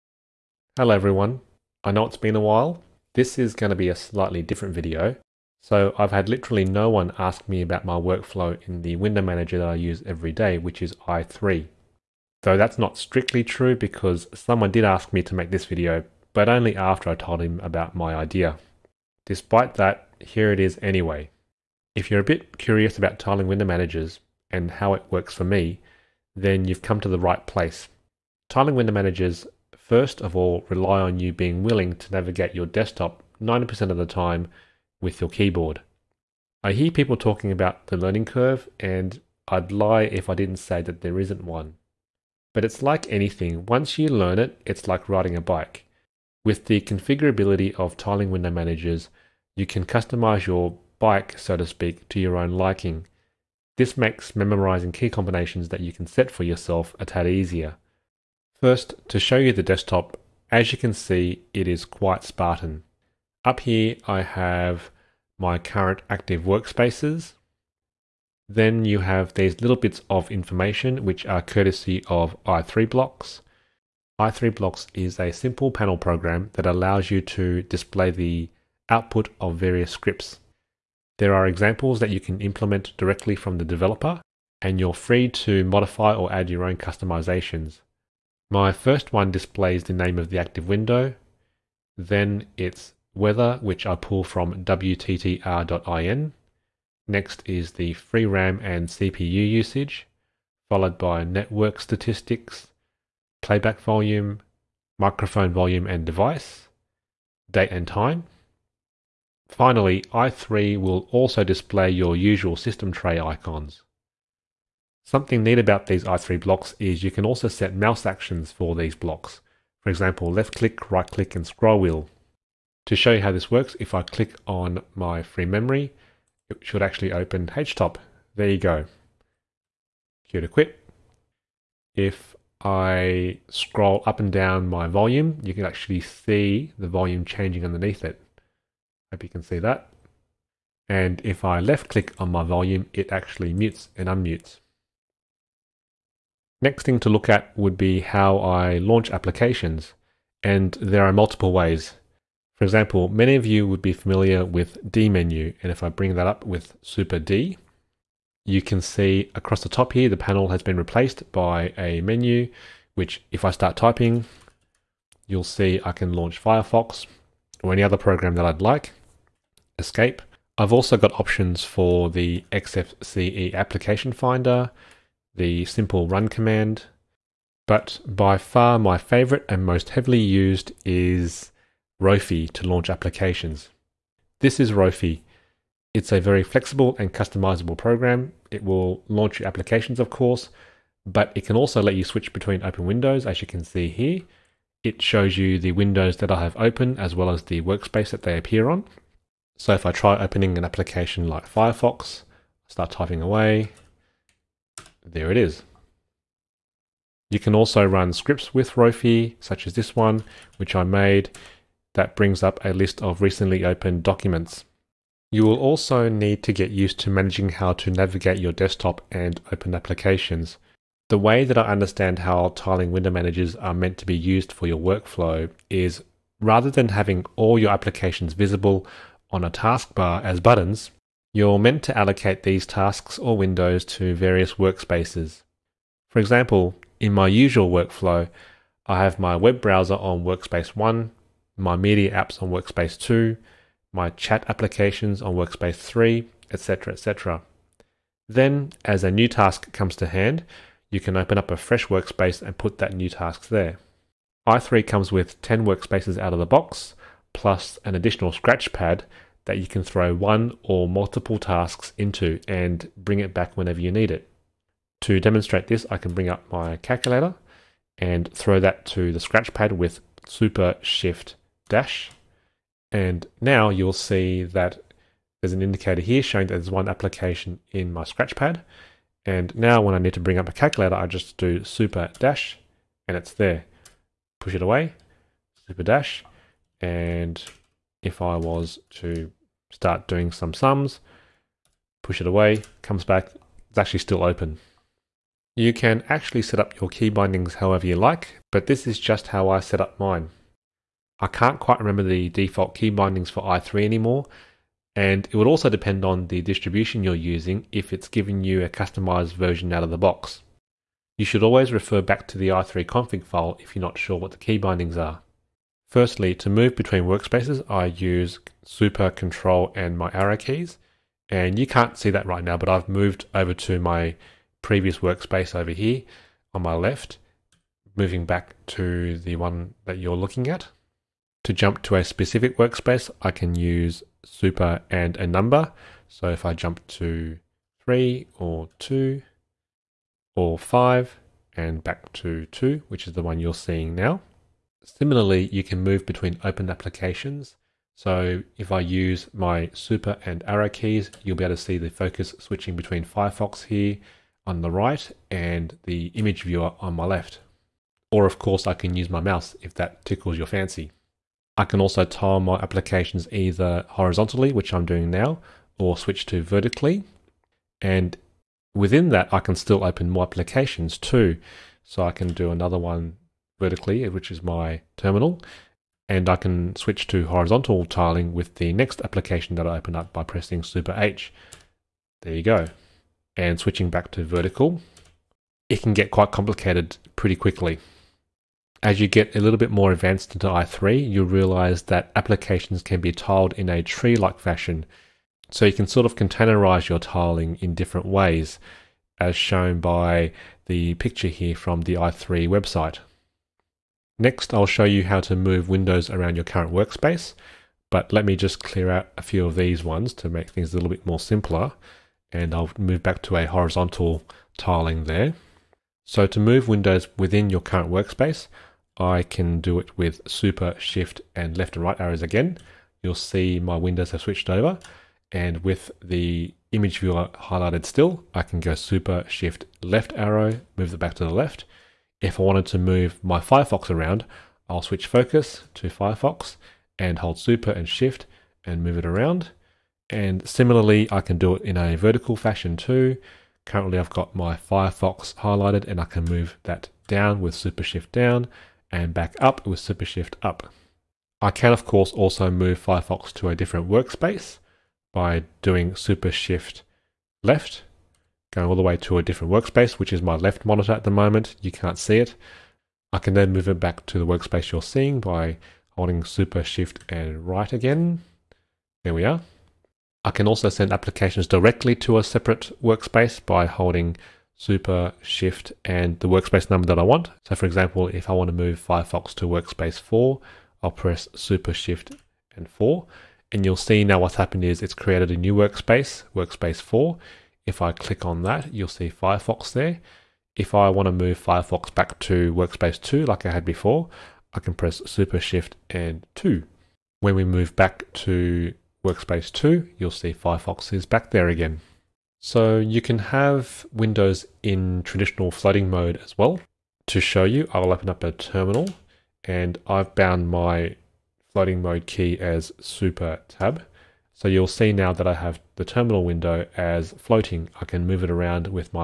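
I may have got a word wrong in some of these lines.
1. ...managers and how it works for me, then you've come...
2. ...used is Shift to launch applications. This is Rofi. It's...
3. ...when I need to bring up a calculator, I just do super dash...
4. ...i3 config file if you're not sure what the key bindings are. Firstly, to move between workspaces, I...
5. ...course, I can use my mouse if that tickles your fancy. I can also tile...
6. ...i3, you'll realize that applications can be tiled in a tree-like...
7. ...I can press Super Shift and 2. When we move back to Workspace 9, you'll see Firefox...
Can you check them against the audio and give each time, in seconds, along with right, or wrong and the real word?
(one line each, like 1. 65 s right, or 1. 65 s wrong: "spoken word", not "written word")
1. 23 s right
2. 180 s wrong: "Rofi", not "Shift"
3. 279 s right
4. 312 s right
5. 358 s right
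6. 390 s right
7. 494 s wrong: "2", not "9".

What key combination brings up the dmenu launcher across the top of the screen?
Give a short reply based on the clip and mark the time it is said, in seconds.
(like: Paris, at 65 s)
Super D, at 156 s.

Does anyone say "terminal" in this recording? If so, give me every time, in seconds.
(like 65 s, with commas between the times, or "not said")
374 s, 508 s, 515 s.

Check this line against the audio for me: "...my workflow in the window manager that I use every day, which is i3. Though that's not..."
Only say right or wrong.
right.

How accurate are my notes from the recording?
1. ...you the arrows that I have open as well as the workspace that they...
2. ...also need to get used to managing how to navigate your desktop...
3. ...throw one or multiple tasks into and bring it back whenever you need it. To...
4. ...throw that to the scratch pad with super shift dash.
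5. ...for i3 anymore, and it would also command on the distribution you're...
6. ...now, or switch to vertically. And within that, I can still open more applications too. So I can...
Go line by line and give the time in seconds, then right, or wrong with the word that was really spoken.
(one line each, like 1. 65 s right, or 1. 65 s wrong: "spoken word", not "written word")
1. 195 s wrong: "windows", not "arrows"
2. 215 s right
3. 259 s right
4. 268 s right
5. 303 s wrong: "depend", not "command"
6. 365 s right.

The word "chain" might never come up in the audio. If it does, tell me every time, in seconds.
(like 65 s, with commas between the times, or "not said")
not said.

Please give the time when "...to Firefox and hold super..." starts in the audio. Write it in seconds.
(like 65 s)
435 s.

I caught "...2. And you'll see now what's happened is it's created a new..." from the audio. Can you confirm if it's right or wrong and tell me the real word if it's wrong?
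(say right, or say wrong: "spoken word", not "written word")
wrong: "4", not "2".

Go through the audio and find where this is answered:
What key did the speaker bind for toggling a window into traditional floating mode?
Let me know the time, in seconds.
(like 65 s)
512 s.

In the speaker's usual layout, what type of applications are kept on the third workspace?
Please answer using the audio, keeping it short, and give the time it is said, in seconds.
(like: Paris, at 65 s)
chat applications, at 244 s.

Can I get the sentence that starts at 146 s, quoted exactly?
Next thing to look at would be how I launch applications.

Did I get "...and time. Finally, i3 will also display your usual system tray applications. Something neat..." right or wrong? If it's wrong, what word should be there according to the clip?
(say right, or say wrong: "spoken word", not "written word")
wrong: "icons", not "applications".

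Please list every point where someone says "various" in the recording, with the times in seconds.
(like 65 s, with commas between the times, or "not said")
79 s, 234 s.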